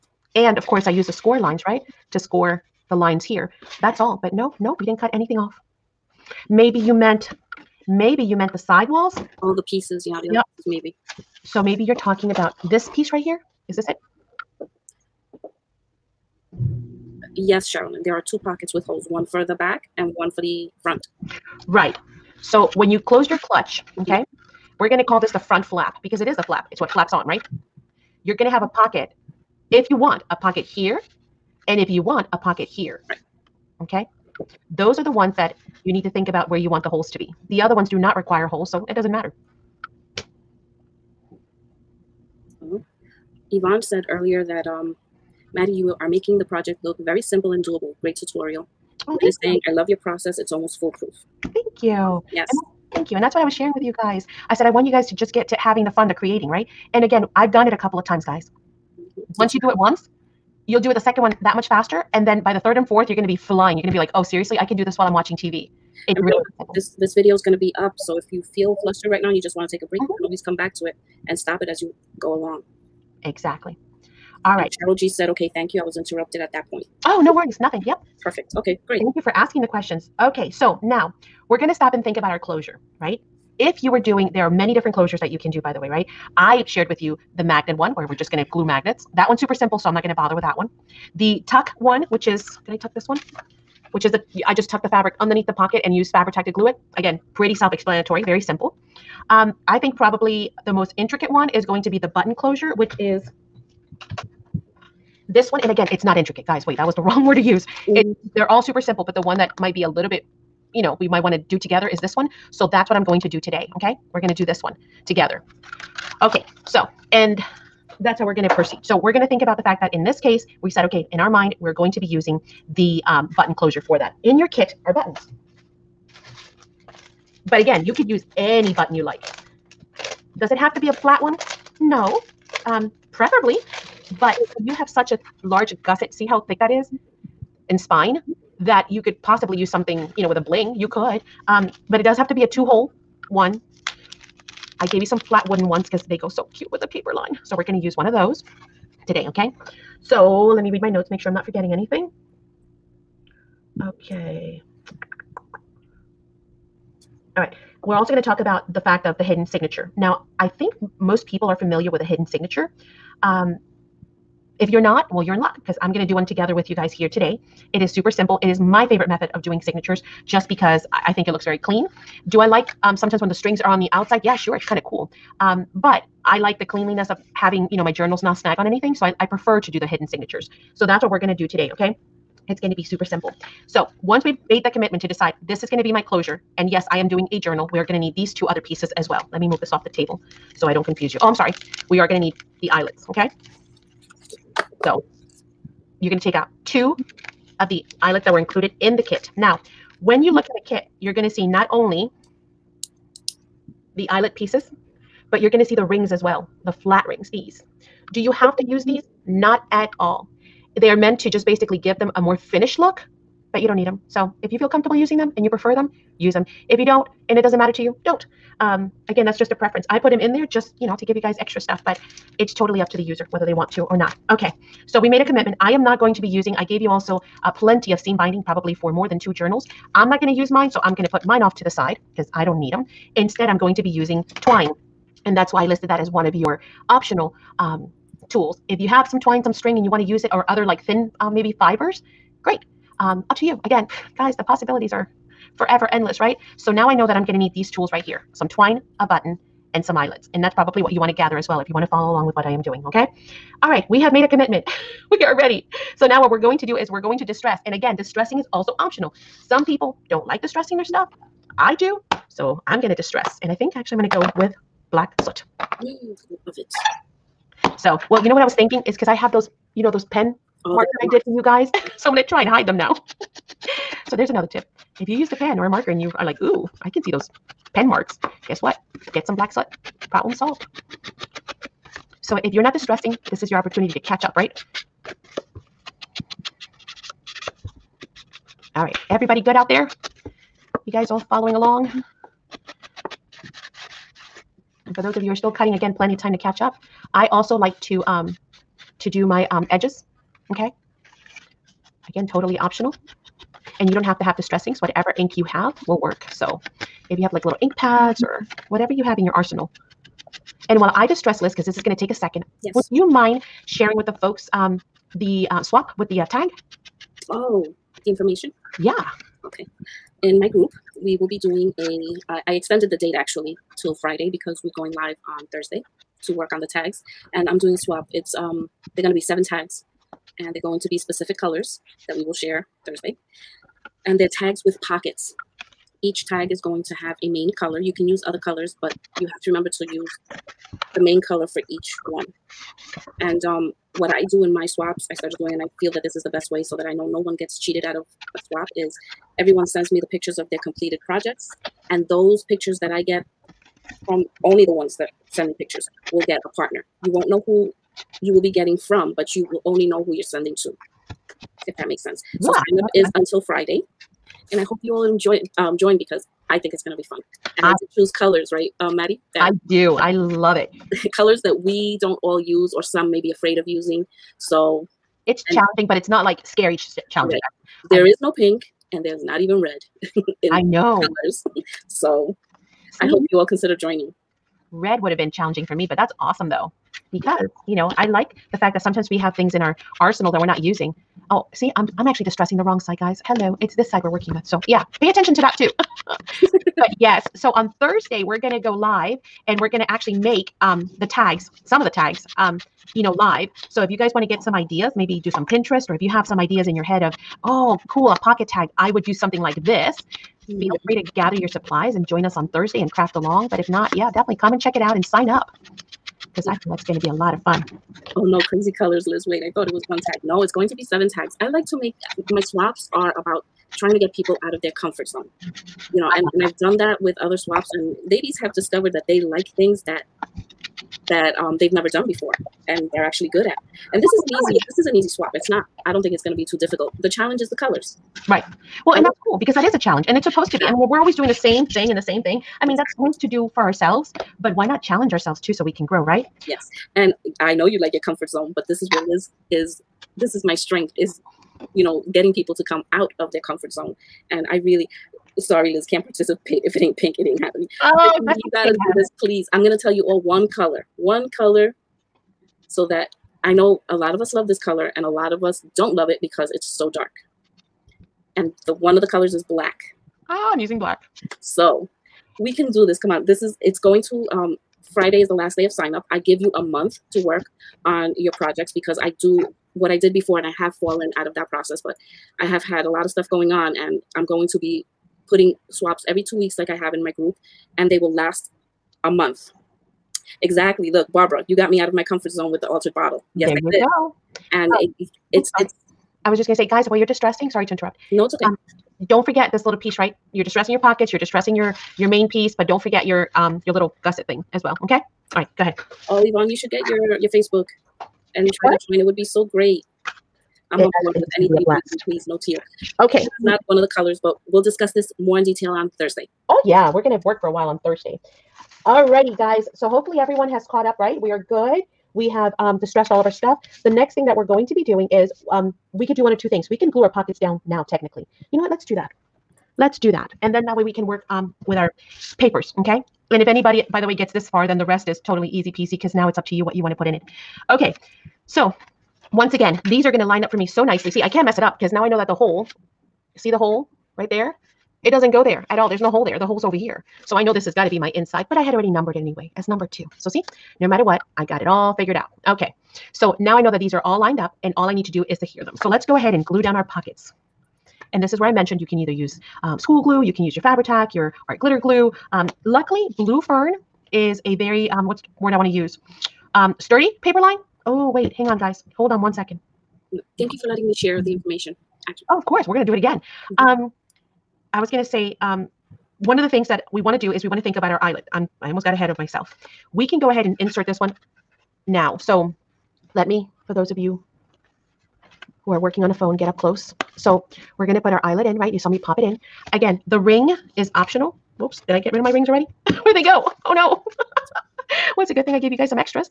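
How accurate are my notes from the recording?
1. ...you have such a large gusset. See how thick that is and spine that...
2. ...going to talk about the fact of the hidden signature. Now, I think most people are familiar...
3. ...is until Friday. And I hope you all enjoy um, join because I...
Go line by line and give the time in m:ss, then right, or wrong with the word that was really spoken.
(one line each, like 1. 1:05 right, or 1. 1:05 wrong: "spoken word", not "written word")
1. 2:14 right
2. 2:38 right
3. 6:02 right.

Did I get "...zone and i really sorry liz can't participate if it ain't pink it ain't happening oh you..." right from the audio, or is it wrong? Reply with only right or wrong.
right.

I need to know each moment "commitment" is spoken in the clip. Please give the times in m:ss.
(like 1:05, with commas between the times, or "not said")
3:04, 3:45, 4:14.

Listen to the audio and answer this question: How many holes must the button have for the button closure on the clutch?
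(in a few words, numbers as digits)
2.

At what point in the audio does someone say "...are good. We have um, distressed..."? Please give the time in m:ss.
8:41.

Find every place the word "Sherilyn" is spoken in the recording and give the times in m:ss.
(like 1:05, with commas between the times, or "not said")
0:17.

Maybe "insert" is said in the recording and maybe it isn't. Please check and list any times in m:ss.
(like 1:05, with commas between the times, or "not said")
9:40.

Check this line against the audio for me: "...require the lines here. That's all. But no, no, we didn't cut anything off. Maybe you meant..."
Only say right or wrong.
wrong.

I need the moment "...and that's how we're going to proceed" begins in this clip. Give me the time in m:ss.
1:57.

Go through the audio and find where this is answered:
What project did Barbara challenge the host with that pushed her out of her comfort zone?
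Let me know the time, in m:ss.
8:12.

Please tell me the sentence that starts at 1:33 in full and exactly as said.
Which is the, I just tucked the fabric underneath the pocket and used Fabri-Tac to glue it.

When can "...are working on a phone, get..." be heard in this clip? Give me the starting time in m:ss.
9:45.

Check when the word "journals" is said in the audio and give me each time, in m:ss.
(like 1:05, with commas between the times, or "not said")
2:57, 3:07, 3:49.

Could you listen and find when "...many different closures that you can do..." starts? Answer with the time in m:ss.
1:24.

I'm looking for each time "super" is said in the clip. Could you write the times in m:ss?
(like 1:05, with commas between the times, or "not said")
1:29, 1:48, 2:47, 3:02.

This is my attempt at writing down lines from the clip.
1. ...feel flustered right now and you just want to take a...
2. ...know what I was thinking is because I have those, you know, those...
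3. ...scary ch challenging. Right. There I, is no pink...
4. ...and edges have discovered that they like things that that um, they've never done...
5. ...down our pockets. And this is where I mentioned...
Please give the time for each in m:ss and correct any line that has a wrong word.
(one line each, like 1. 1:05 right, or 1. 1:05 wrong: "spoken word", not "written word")
1. 1:08 right
2. 4:28 right
3. 6:16 right
4. 7:07 wrong: "ladies", not "edges"
5. 9:16 right.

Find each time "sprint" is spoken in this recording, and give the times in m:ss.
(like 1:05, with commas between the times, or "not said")
not said.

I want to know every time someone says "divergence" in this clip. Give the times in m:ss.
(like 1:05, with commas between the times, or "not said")
not said.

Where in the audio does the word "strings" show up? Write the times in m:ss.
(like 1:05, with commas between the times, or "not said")
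2:53, 3:59.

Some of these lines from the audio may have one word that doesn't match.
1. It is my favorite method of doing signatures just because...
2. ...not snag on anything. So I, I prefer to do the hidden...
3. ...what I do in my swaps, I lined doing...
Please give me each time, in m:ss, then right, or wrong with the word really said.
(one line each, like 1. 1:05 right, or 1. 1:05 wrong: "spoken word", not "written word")
1. 2:48 right
2. 2:58 right
3. 5:43 wrong: "started", not "lined".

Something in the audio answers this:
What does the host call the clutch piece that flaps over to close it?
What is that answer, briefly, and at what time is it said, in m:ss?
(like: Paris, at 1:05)
the front flap, at 0:25.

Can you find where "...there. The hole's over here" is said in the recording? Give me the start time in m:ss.
9:06.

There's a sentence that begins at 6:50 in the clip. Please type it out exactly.
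free to gather your supplies and join us on Thursday and craft along.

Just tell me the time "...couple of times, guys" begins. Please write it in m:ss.
0:57.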